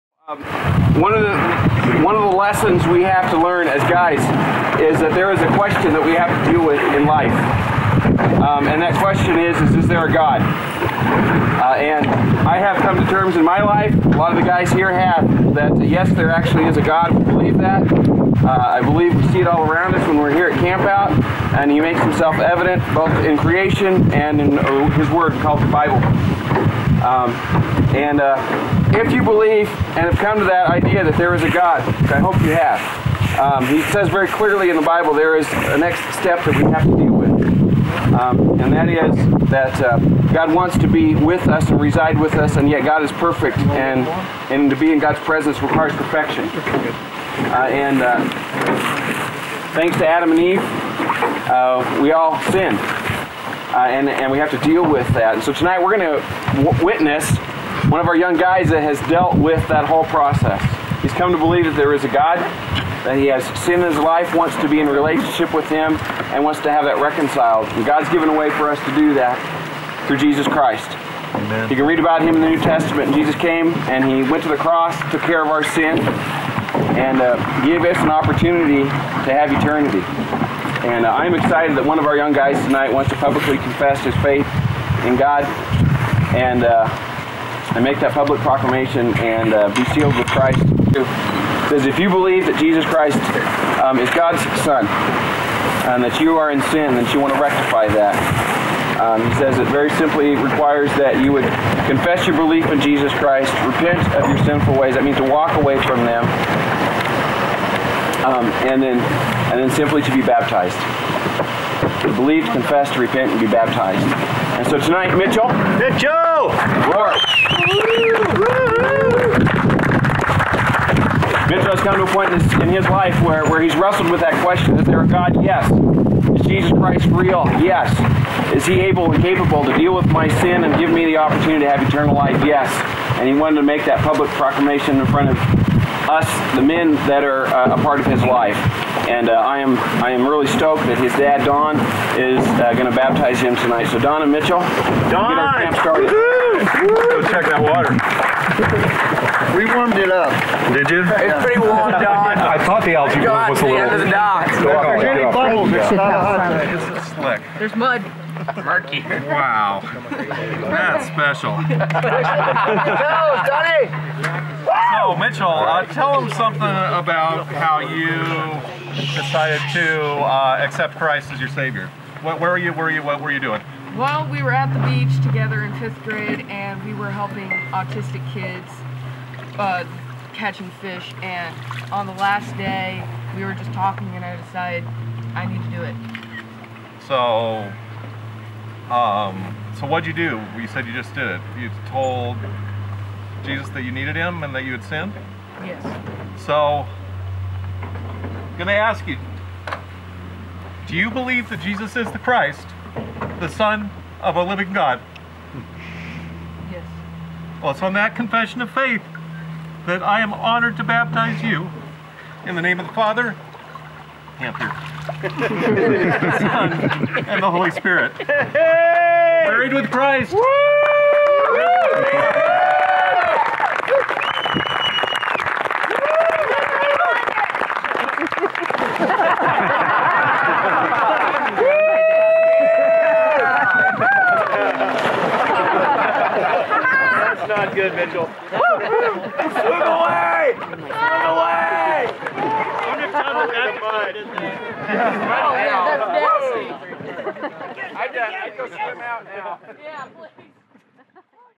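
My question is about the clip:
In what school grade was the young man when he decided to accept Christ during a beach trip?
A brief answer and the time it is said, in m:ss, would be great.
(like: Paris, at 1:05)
fifth grade, at 2:55.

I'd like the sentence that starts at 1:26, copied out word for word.
And uh, and make that public proclamation and uh, be sealed with Christ.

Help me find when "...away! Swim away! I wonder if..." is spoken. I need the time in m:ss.
3:58.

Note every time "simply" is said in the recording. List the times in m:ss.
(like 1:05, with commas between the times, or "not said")
1:39, 1:49.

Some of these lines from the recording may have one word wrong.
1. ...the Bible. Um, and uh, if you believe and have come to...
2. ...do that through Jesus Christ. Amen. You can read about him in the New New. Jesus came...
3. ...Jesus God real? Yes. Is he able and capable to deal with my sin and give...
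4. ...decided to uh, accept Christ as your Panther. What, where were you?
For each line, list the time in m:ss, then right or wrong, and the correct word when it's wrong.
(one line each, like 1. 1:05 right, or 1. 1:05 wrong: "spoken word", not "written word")
1. 0:25 right
2. 1:08 wrong: "Testament", not "New"
3. 2:06 wrong: "Christ", not "God"
4. 2:49 wrong: "Savior", not "Panther".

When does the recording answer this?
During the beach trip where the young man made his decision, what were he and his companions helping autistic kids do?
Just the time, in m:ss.
3:00.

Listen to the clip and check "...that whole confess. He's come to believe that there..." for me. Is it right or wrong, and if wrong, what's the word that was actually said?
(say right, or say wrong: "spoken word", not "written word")
wrong: "process", not "confess".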